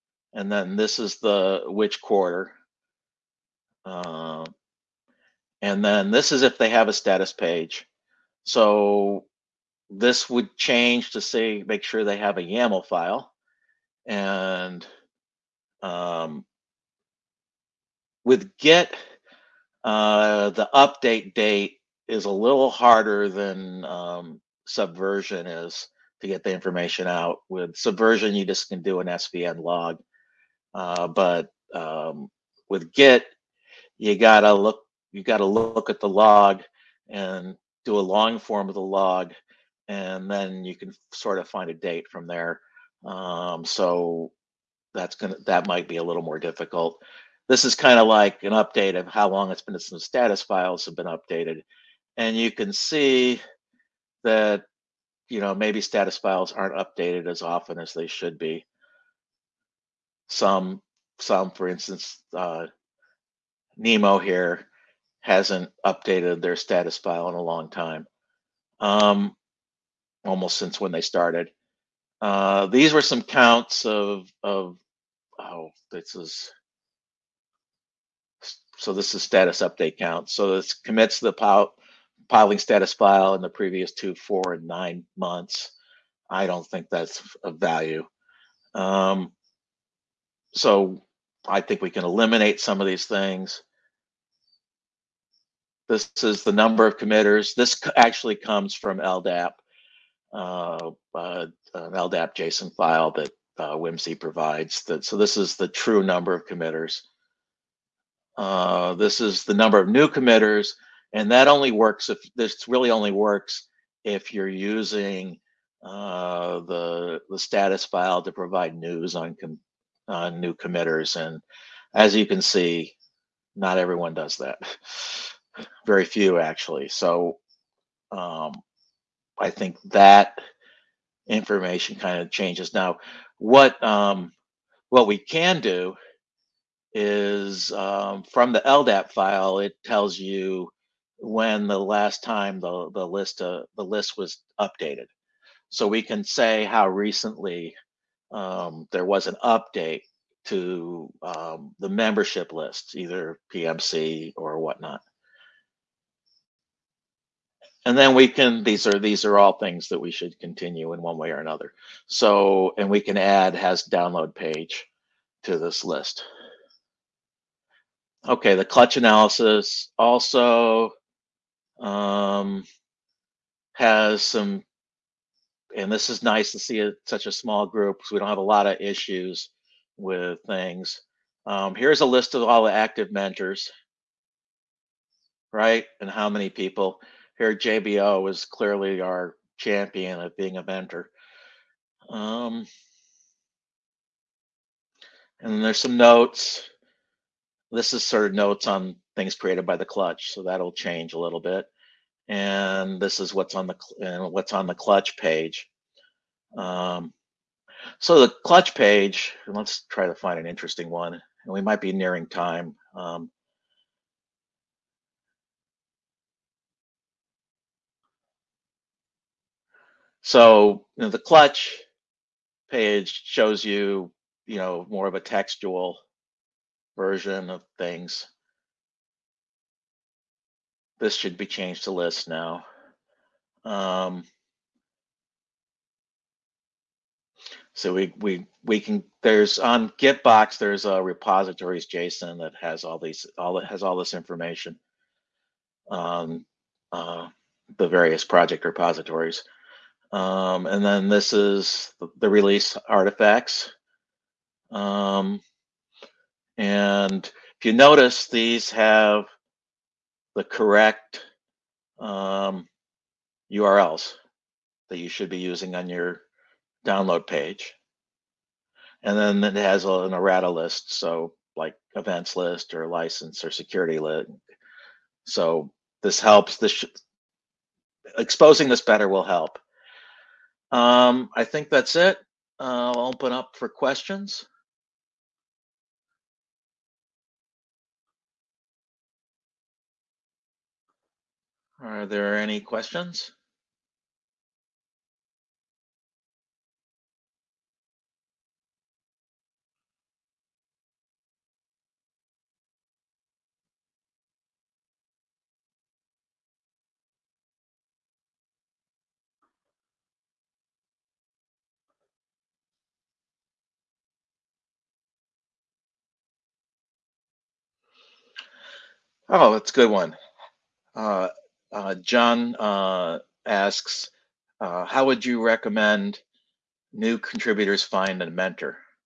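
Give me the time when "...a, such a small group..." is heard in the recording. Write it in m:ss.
2:56.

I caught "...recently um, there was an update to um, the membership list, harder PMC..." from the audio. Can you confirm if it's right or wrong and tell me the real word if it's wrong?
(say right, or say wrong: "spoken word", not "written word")
wrong: "either", not "harder".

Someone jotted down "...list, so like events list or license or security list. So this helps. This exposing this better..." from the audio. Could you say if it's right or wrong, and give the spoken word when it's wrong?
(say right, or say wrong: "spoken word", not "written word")
right.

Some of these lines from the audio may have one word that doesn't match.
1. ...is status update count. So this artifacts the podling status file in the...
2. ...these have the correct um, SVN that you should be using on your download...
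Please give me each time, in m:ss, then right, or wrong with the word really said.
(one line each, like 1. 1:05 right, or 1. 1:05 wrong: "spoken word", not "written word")
1. 1:19 wrong: "commits", not "artifacts"
2. 4:18 wrong: "URLs", not "SVN".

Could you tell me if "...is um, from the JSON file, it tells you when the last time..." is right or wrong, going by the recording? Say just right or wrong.
wrong.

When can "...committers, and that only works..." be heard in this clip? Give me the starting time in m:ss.
1:50.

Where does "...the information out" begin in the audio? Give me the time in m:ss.
0:26.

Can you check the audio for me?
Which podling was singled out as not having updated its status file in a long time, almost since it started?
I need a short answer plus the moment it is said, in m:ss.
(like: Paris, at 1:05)
Nemo, at 1:03.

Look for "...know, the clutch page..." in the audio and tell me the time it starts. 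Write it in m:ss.
3:41.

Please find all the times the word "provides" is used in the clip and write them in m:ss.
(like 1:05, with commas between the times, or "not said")
1:44, 1:58.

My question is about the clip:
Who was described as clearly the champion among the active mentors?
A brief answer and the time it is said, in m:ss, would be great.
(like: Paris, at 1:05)
JBO, at 3:07.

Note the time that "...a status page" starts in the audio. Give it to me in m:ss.
0:06.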